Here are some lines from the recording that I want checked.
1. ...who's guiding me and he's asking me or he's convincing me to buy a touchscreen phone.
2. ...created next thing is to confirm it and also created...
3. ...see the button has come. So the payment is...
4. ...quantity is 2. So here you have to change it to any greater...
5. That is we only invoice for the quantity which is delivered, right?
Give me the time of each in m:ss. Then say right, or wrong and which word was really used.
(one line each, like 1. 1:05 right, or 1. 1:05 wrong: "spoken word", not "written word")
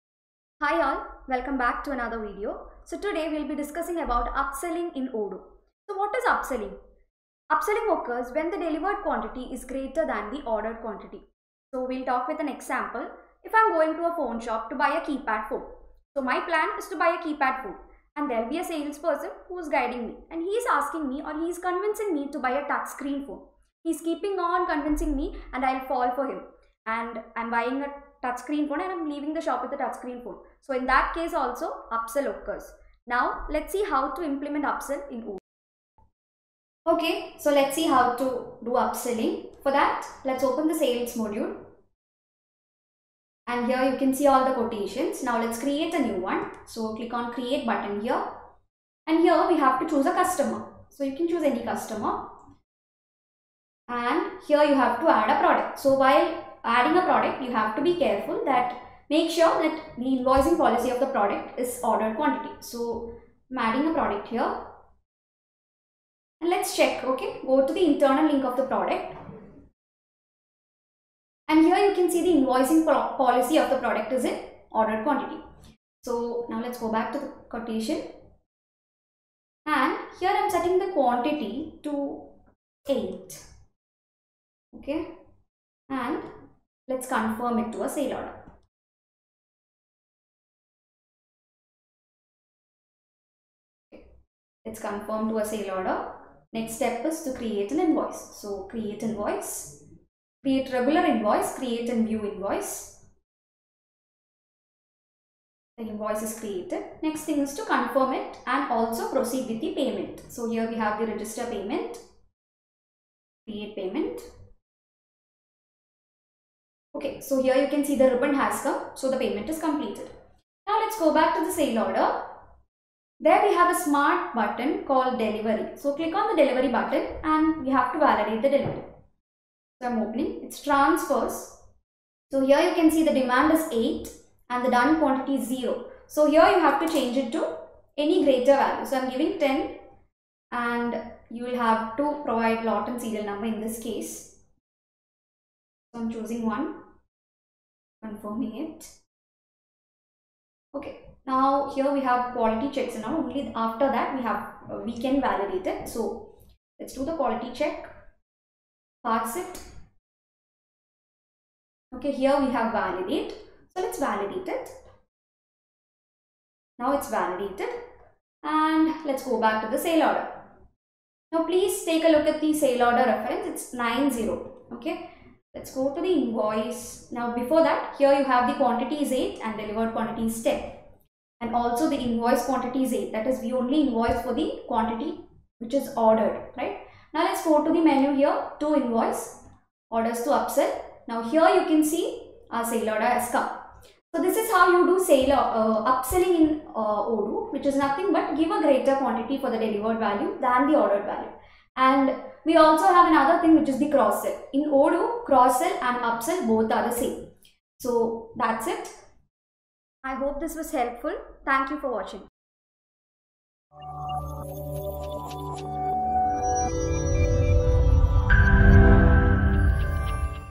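1. 0:19 right
2. 1:46 wrong: "proceed", not "created"
3. 1:57 wrong: "ribbon", not "button"
4. 2:14 wrong: "0", not "2"
5. 3:03 wrong: "ordered", not "delivered".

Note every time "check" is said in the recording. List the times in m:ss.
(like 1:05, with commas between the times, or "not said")
1:06, 2:32, 2:37.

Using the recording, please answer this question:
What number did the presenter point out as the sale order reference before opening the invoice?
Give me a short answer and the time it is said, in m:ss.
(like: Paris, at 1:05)
90, at 2:53.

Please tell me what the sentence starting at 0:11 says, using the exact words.
So we'll talk with an example.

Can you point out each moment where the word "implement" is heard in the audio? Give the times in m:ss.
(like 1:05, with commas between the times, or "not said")
0:34.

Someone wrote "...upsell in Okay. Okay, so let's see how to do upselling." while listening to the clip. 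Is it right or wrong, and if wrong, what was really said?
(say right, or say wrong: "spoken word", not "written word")
wrong: "Odoo", not "Okay".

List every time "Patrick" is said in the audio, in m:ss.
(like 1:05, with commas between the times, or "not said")
not said.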